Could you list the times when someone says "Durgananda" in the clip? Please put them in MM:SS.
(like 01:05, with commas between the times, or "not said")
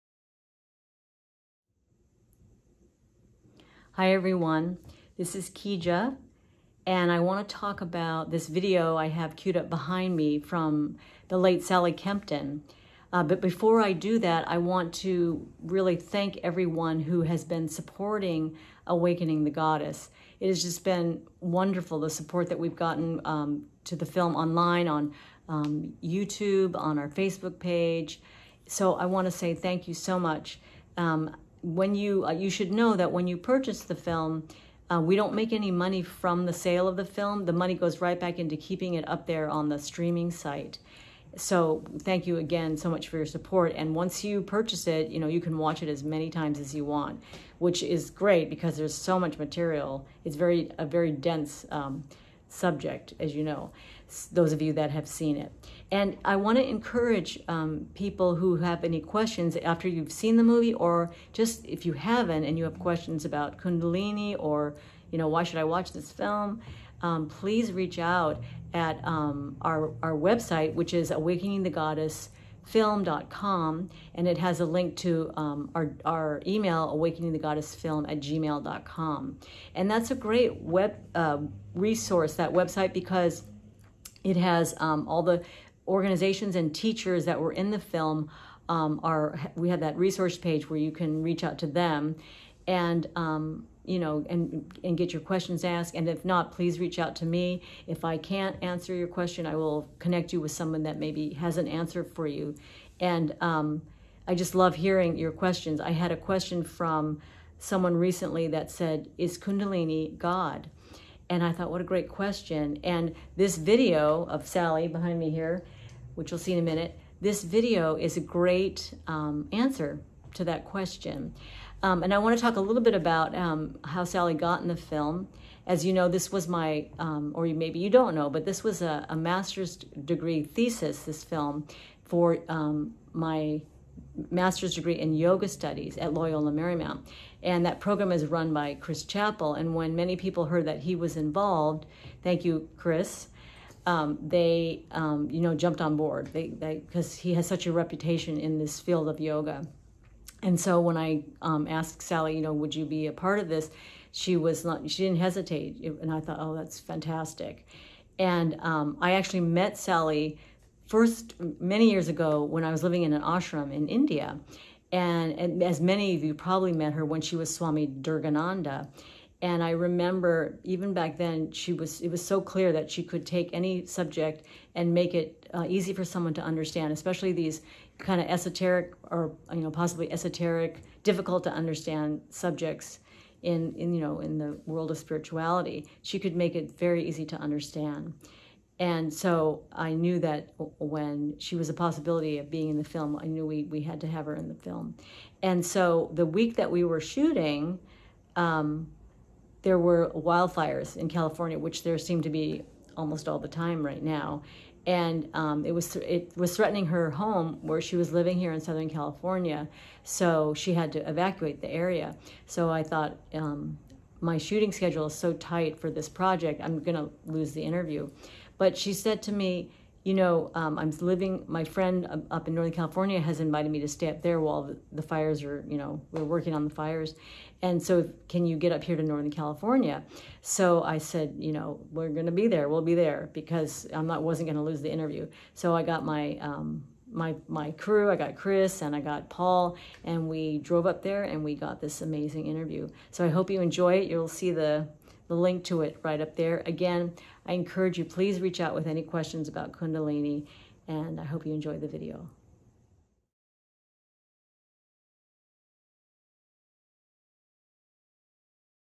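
02:47.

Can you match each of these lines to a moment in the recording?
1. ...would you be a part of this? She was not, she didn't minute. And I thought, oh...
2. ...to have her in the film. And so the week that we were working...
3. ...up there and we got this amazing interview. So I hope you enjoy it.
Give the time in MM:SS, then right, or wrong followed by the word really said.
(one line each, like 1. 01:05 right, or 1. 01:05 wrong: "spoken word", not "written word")
1. 02:32 wrong: "hesitate", not "minute"
2. 03:14 wrong: "shooting", not "working"
3. 04:00 right.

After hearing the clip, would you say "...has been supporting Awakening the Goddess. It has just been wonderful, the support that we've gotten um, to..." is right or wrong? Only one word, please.
right.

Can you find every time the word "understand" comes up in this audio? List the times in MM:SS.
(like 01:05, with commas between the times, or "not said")
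02:56, 03:01, 03:07.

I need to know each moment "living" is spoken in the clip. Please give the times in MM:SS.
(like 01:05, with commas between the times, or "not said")
02:42, 03:28, 03:41.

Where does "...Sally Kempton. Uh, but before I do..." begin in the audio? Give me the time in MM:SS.
00:11.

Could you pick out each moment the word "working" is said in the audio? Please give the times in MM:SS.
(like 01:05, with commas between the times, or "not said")
03:46.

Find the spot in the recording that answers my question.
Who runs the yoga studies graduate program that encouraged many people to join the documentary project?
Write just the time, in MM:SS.
02:18.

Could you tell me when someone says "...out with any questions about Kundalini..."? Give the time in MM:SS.
04:08.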